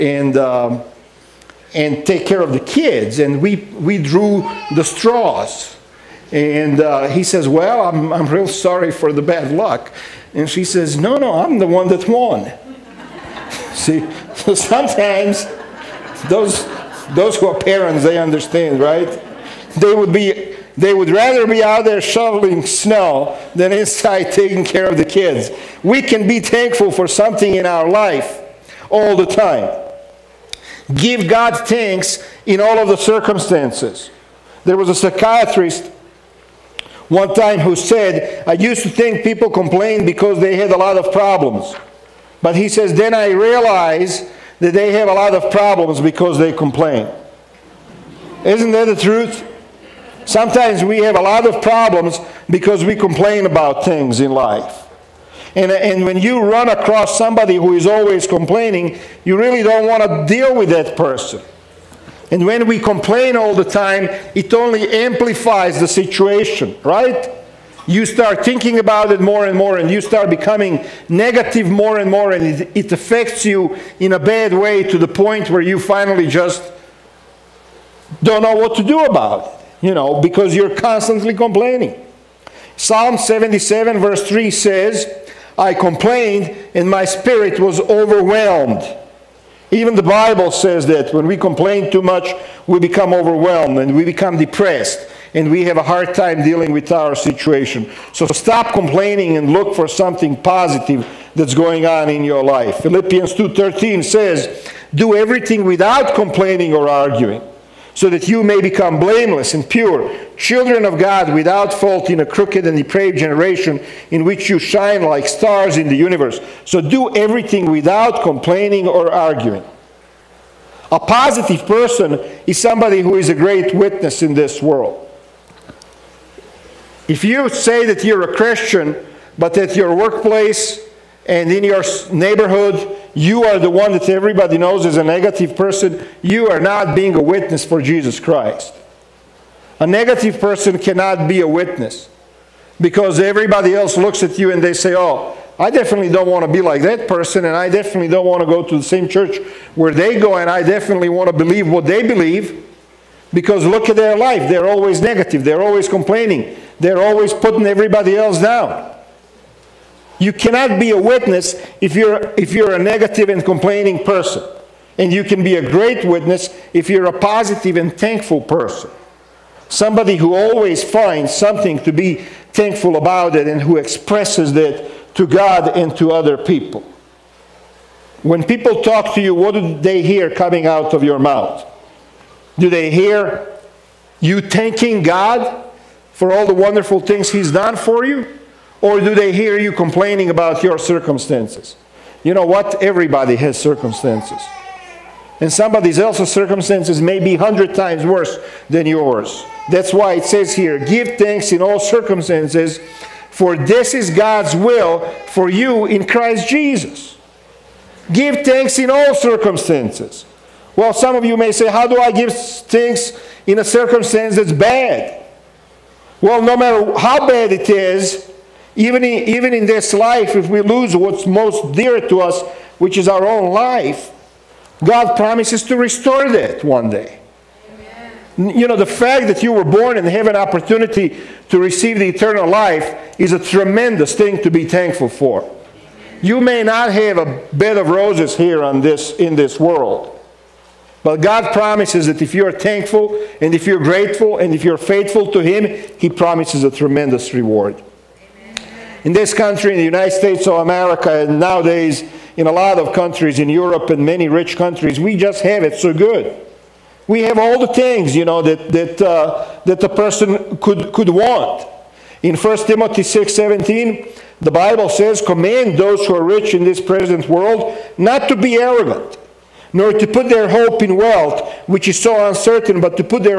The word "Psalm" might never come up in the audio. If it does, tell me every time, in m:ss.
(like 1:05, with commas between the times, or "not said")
1:22.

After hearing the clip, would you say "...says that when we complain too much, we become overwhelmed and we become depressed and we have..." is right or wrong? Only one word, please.
right.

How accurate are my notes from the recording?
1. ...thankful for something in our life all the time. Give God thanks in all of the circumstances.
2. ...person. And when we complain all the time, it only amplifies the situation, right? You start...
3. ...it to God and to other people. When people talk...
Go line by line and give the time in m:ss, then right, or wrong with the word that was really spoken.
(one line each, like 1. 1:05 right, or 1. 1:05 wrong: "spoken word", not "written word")
1. 0:26 right
2. 1:00 right
3. 2:54 right.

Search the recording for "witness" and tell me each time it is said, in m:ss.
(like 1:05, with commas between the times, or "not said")
2:03, 2:17, 2:21, 2:40, 2:46.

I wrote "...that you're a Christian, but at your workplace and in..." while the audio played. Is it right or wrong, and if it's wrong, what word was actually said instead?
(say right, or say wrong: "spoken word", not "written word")
right.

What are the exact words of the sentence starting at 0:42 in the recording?
But he says, then I realized that they have a lot of problems because they complain.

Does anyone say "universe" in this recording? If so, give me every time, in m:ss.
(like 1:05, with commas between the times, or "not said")
1:55.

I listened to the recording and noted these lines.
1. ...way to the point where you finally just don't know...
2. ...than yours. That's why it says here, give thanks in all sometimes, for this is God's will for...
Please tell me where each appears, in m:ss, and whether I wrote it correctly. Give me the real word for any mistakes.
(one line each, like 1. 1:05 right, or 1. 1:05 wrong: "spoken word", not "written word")
1. 1:14 right
2. 3:18 wrong: "circumstances", not "sometimes".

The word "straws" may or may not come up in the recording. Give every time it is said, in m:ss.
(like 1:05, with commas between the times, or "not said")
0:04.